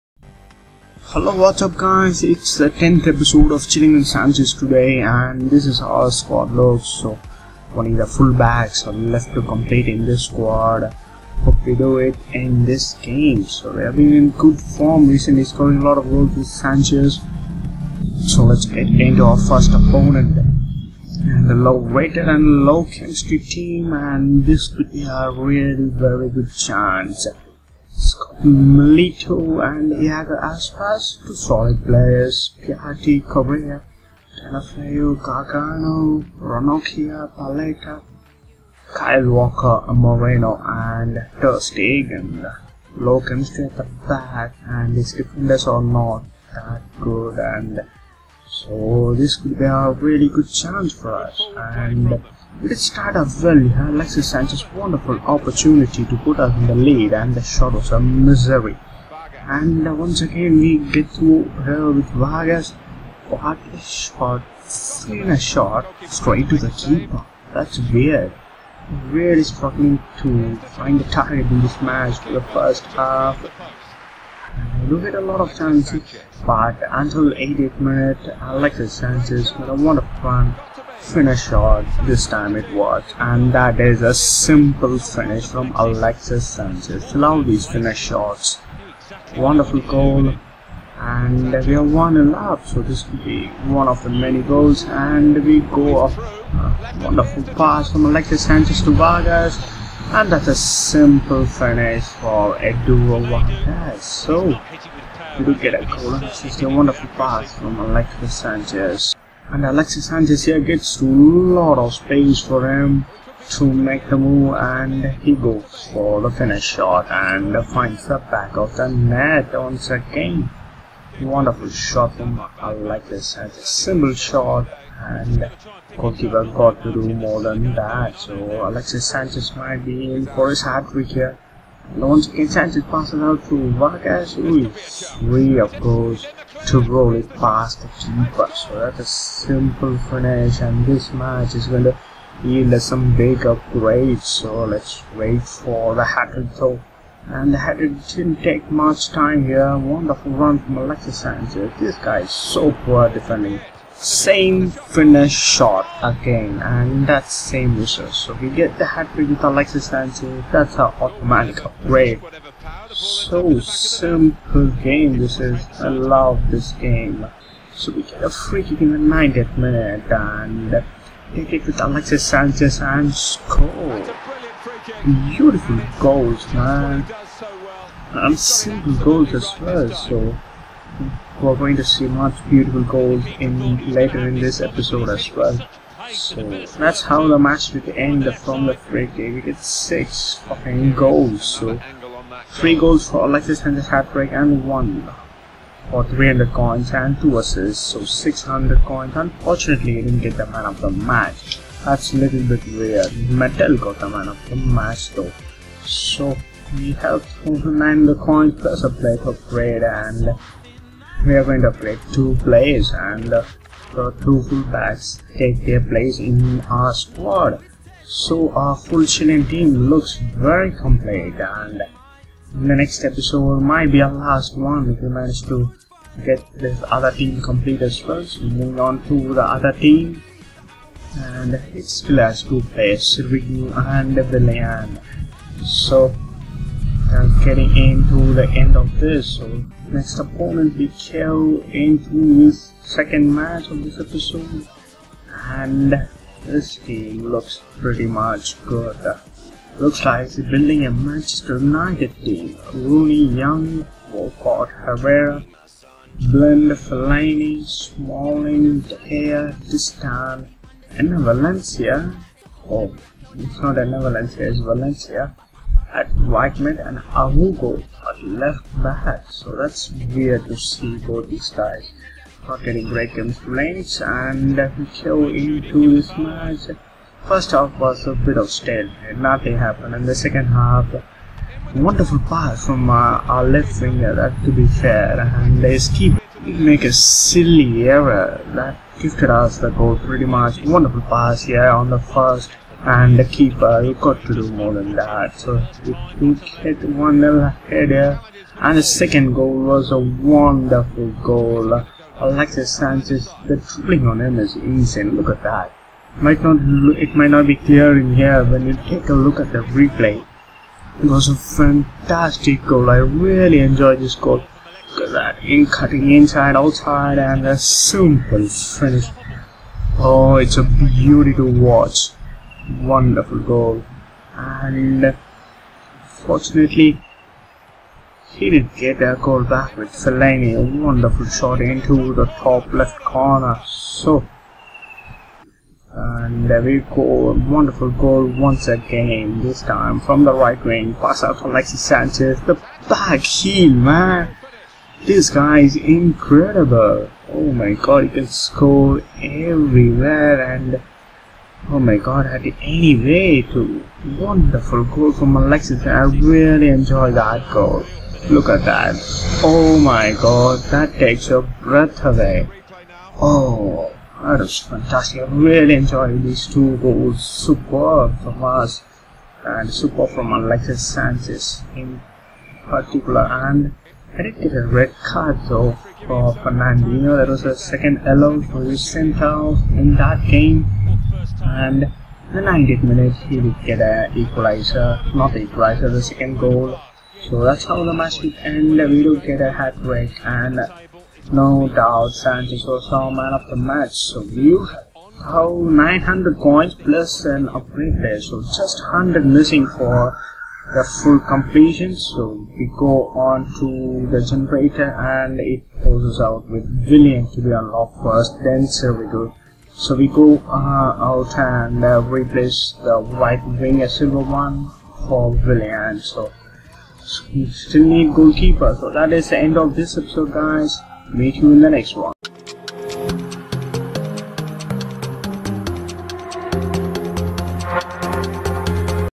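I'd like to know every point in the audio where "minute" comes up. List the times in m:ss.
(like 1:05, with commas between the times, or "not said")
1:17, 2:49, 6:22.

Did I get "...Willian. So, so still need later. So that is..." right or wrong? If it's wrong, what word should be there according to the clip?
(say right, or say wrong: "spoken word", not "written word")
wrong: "goalkeeper", not "later".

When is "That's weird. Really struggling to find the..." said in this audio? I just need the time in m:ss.
1:07.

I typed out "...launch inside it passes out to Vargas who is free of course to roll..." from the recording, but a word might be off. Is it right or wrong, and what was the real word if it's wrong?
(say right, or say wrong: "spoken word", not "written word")
right.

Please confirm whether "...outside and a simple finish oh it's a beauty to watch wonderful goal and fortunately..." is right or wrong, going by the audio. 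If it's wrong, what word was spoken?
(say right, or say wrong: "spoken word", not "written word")
right.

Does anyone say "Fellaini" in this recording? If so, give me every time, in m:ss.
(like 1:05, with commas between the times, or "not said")
4:16, 5:29.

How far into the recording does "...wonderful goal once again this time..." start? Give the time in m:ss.
5:37.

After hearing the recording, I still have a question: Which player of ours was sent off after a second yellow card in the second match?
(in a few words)
Fernandinho.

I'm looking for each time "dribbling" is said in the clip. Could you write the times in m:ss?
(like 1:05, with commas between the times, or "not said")
5:03.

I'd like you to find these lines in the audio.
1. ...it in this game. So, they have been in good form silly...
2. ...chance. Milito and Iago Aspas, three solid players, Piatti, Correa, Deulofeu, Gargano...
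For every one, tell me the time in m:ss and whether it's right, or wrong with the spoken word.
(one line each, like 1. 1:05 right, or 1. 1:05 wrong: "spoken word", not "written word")
1. 0:11 wrong: "recently", not "silly"
2. 0:26 wrong: "two", not "three".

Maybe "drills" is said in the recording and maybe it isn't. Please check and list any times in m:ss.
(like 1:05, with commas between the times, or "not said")
not said.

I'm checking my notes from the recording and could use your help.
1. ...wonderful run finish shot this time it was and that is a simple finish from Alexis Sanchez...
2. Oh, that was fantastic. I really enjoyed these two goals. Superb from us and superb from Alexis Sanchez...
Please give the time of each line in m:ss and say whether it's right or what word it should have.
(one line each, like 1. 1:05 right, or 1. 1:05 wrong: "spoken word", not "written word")
1. 1:19 right
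2. 6:03 right.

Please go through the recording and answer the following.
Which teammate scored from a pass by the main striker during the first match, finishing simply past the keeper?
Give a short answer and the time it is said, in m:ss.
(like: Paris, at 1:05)
Eduardo Vargas, at 1:42.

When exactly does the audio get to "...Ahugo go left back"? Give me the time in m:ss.
4:26.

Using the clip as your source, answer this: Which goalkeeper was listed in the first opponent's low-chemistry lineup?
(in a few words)
Ter Stegen.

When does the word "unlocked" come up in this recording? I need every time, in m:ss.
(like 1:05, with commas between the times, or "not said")
6:47.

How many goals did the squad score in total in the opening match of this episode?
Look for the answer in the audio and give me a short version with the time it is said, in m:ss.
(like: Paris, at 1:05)
6, at 3:09.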